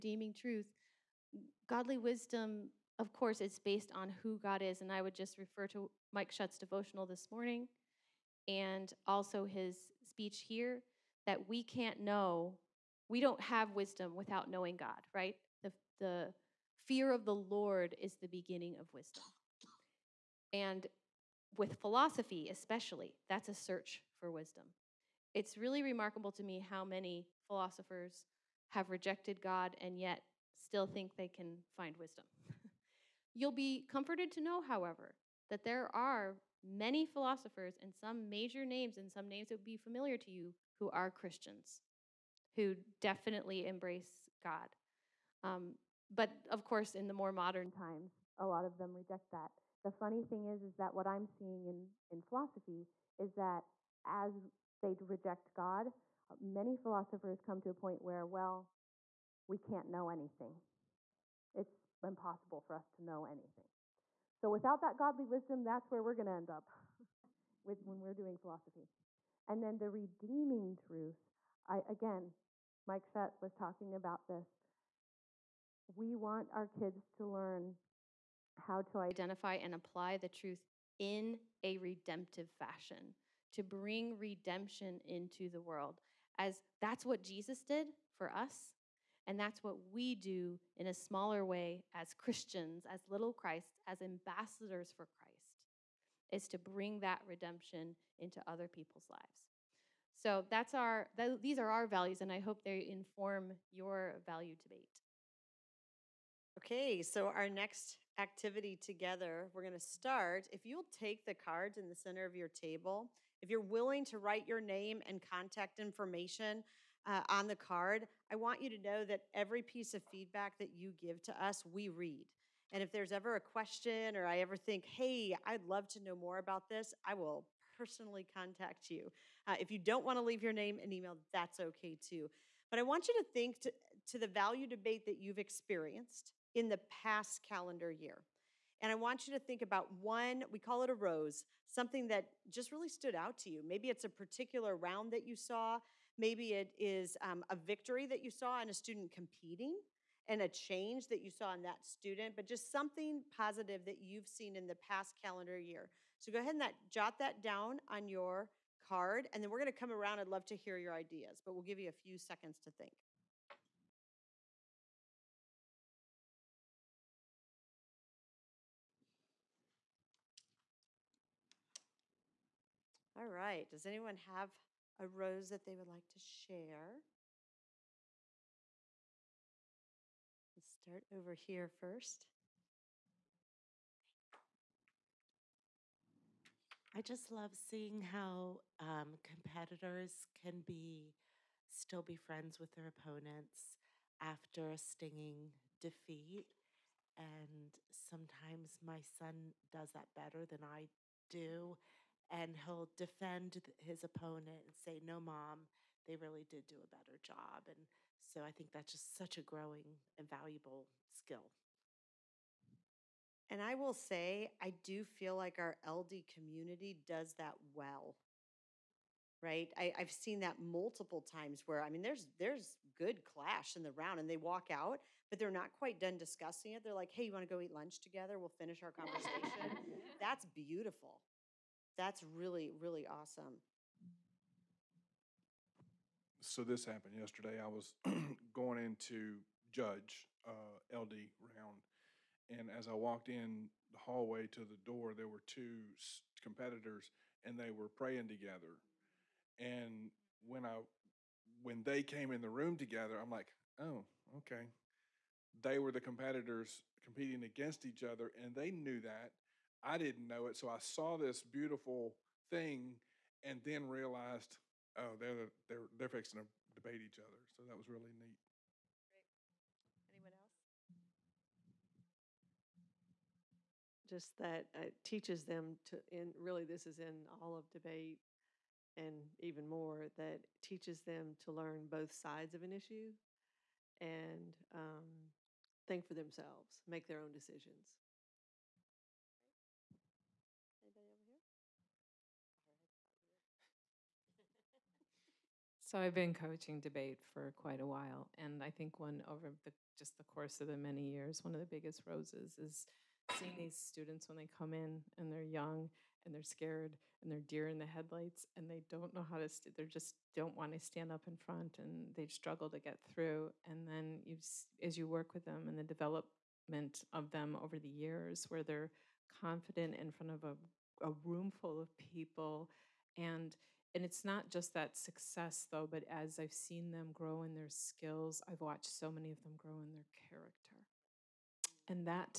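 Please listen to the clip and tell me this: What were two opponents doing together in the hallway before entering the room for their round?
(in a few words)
praying.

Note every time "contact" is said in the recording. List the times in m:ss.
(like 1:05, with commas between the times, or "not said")
1:55, 2:08.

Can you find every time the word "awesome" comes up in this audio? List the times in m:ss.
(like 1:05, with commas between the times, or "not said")
3:53.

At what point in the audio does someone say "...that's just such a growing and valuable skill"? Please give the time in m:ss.
3:28.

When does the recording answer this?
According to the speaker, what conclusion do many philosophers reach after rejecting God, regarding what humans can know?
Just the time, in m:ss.
0:59.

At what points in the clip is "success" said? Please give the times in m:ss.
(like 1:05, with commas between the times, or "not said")
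5:24.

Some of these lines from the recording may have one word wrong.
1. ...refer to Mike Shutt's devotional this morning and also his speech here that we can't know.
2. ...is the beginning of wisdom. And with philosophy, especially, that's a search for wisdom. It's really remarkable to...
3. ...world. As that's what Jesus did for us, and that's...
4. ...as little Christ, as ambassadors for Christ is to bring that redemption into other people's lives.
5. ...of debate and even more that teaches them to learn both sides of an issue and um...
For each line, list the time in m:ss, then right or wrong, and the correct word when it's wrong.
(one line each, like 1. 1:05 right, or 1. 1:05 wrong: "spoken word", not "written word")
1. 0:05 right
2. 0:17 right
3. 1:25 right
4. 1:32 right
5. 4:37 right.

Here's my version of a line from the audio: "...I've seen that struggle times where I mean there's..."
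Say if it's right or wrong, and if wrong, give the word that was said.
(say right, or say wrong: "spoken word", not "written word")
wrong: "multiple", not "struggle".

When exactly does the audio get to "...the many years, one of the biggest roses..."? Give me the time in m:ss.
5:00.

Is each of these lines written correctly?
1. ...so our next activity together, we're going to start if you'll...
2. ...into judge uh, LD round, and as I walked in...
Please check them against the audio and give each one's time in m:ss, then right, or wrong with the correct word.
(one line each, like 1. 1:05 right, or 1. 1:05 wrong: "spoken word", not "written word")
1. 1:47 right
2. 3:58 right.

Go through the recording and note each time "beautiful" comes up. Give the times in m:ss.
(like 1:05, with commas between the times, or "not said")
3:50, 4:21.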